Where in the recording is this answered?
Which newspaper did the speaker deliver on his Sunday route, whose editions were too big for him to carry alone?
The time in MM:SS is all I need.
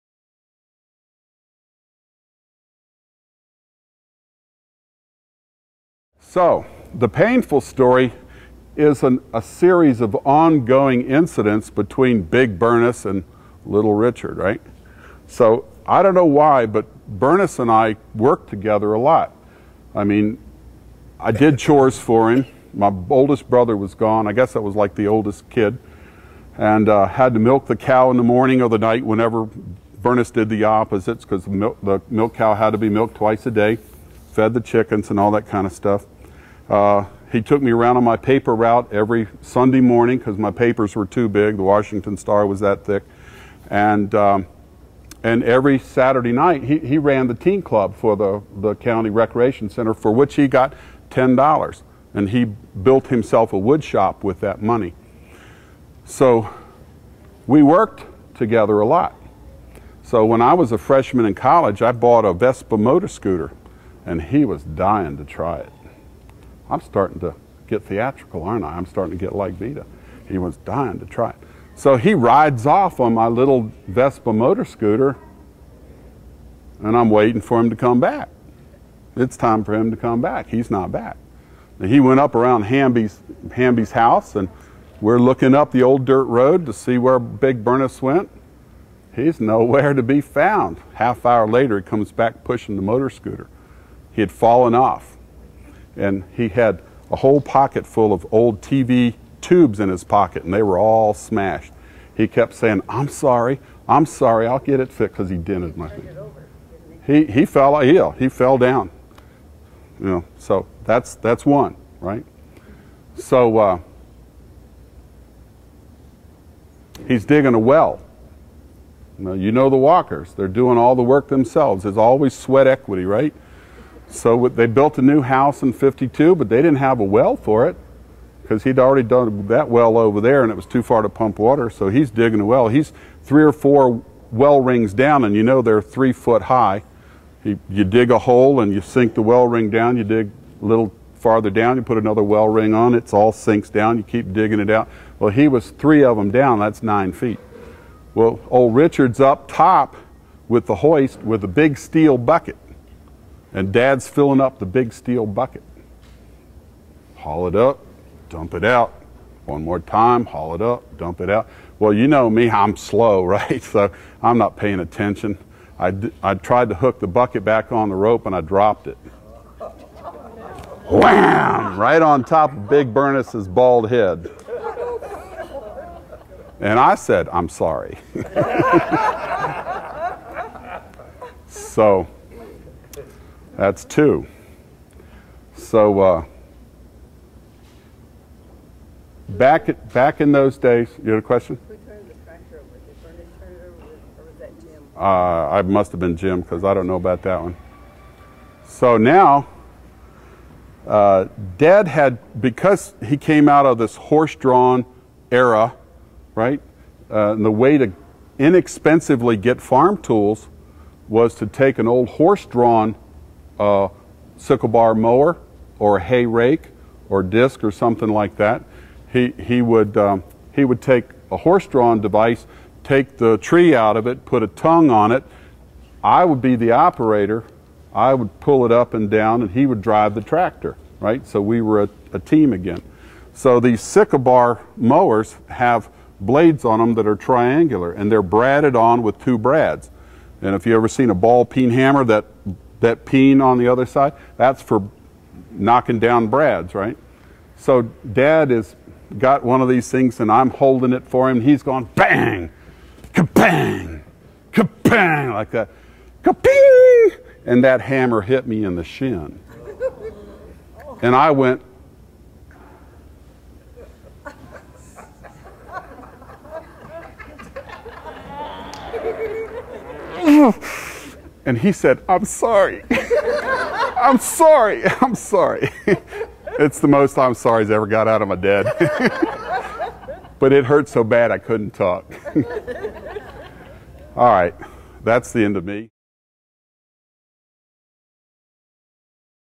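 00:41.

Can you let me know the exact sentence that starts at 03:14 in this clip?
Uh, I must have been Jim because I don't know about that one.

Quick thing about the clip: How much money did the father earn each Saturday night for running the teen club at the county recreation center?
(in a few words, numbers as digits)
$10.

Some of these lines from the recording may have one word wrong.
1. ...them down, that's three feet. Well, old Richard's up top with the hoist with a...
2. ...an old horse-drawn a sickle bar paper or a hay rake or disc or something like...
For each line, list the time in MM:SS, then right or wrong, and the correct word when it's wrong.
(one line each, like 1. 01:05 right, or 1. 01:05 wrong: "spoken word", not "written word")
1. 02:26 wrong: "nine", not "three"
2. 03:31 wrong: "mower", not "paper".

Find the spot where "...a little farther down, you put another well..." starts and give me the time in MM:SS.
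02:20.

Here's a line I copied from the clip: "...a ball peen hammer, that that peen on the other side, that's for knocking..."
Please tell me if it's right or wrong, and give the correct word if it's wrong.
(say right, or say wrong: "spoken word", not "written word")
right.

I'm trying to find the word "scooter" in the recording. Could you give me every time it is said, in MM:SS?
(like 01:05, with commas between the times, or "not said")
01:03, 01:14, 01:33.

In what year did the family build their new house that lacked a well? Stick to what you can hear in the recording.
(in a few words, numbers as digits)
1952.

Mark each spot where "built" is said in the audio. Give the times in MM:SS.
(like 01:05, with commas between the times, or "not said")
00:52, 02:04.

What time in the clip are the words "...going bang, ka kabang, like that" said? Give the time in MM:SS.
04:11.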